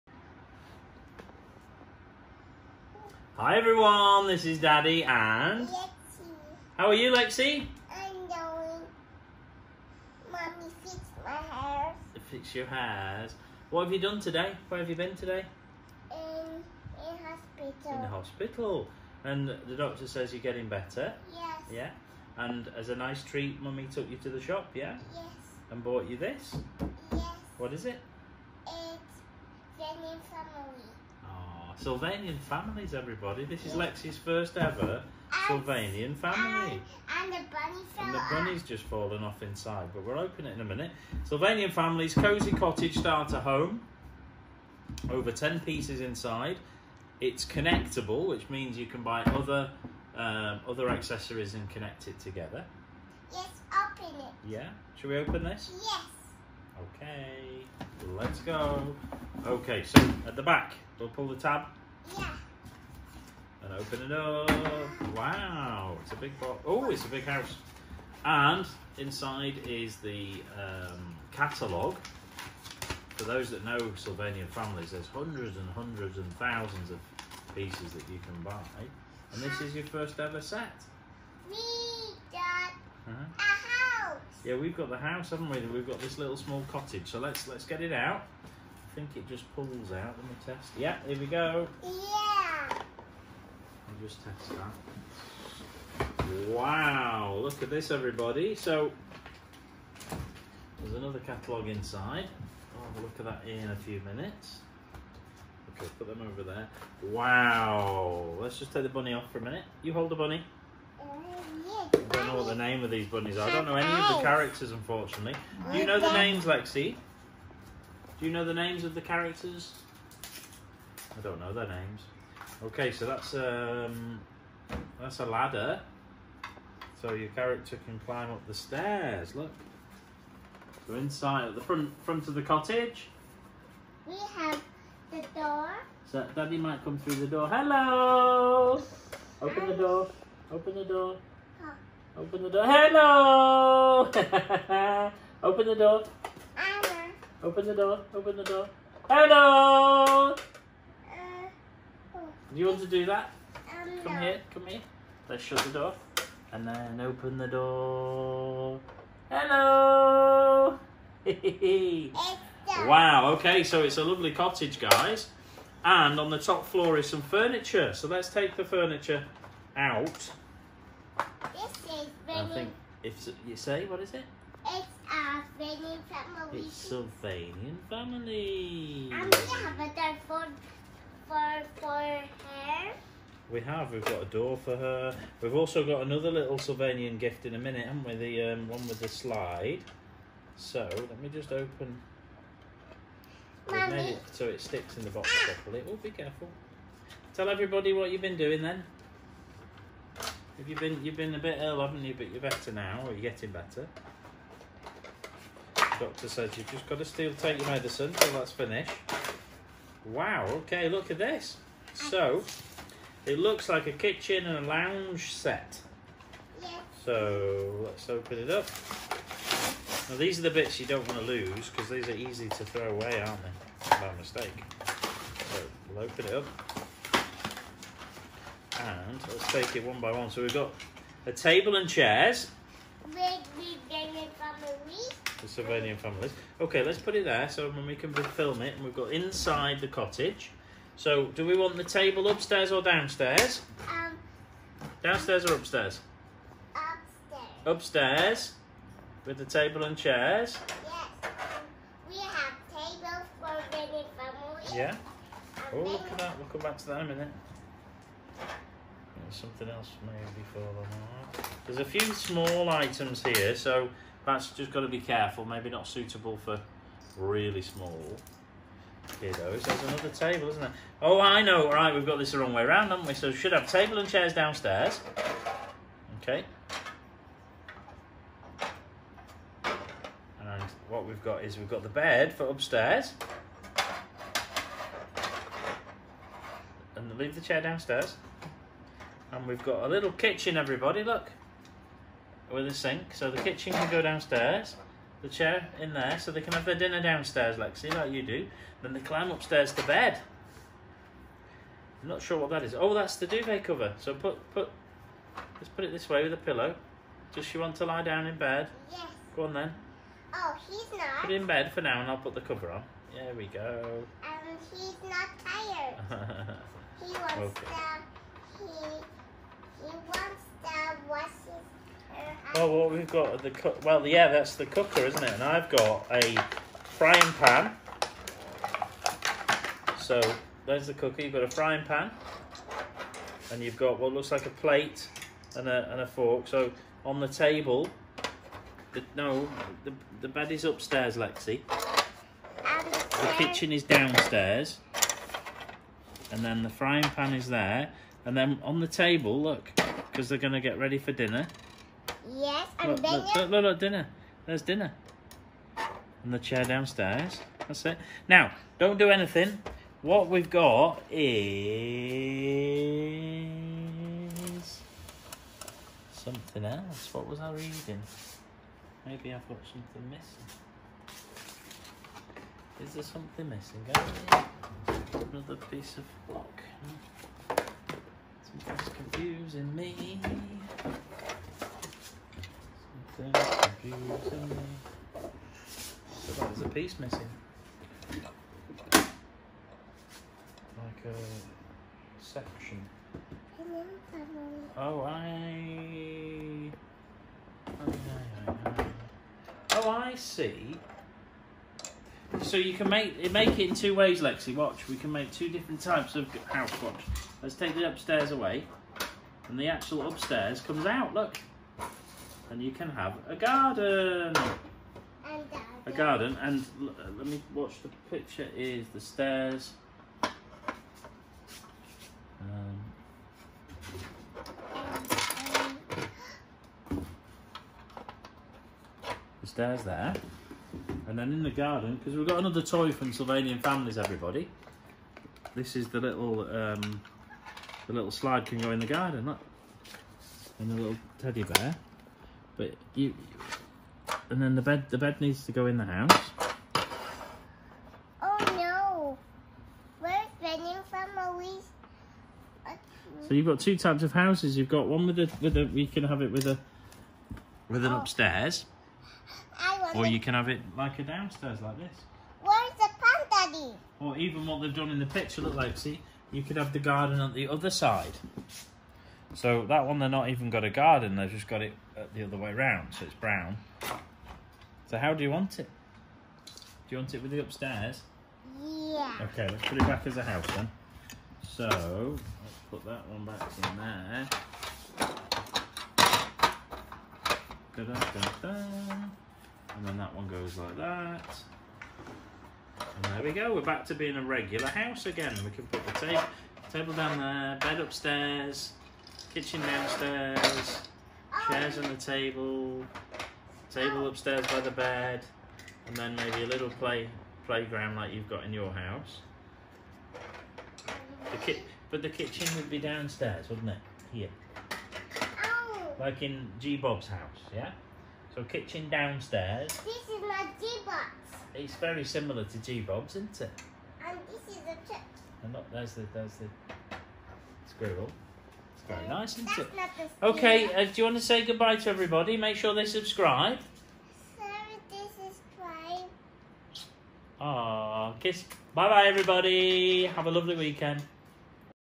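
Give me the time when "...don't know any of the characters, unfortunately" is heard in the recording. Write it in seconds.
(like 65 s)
113 s.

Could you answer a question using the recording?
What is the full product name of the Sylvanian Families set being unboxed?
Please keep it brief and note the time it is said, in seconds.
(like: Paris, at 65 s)
Cozy cottage starter home, at 42 s.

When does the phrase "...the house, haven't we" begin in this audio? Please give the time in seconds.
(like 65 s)
84 s.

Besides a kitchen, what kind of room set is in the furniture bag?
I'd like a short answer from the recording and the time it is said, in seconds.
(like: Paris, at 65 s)
Lounge, at 214 s.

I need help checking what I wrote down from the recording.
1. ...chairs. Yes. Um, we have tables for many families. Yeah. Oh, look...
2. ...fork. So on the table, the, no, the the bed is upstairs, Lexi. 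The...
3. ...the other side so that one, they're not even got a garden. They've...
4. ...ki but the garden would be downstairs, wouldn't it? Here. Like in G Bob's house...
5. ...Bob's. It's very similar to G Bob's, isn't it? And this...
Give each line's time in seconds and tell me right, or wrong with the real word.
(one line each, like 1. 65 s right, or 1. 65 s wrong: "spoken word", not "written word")
1. 249 s right
2. 336 s right
3. 467 s right
4. 511 s wrong: "kitchen", not "garden"
5. 520 s right.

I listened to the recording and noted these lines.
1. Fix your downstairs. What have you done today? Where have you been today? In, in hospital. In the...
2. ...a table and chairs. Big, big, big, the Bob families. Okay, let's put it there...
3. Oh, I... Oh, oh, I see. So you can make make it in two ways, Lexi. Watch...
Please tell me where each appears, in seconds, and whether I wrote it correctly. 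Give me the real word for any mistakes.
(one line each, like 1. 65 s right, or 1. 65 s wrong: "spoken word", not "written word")
1. 12 s wrong: "hairs", not "downstairs"
2. 231 s wrong: "Sylvanian", not "Bob"
3. 394 s right.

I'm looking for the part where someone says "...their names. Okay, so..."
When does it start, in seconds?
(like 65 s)
121 s.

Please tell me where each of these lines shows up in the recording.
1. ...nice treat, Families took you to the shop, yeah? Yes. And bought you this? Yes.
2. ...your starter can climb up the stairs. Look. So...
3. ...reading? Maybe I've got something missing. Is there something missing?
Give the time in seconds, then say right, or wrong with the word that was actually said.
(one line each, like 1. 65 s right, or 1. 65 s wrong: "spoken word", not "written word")
1. 22 s wrong: "Mummy", not "Families"
2. 127 s wrong: "character", not "starter"
3. 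367 s right.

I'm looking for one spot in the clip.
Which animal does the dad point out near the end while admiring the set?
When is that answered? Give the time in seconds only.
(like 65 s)
527 s.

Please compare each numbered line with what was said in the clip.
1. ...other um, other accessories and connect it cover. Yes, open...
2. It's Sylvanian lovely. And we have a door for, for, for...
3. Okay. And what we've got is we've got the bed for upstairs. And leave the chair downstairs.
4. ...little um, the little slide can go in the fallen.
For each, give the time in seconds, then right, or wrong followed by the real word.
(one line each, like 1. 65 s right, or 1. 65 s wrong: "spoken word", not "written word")
1. 49 s wrong: "together", not "cover"
2. 176 s wrong: "family", not "lovely"
3. 276 s right
4. 436 s wrong: "garden", not "fallen".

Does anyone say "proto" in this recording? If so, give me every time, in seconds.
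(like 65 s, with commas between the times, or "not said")
not said.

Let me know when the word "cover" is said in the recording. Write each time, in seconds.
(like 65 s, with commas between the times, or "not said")
303 s, 312 s.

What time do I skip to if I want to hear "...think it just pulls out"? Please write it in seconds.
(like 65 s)
88 s.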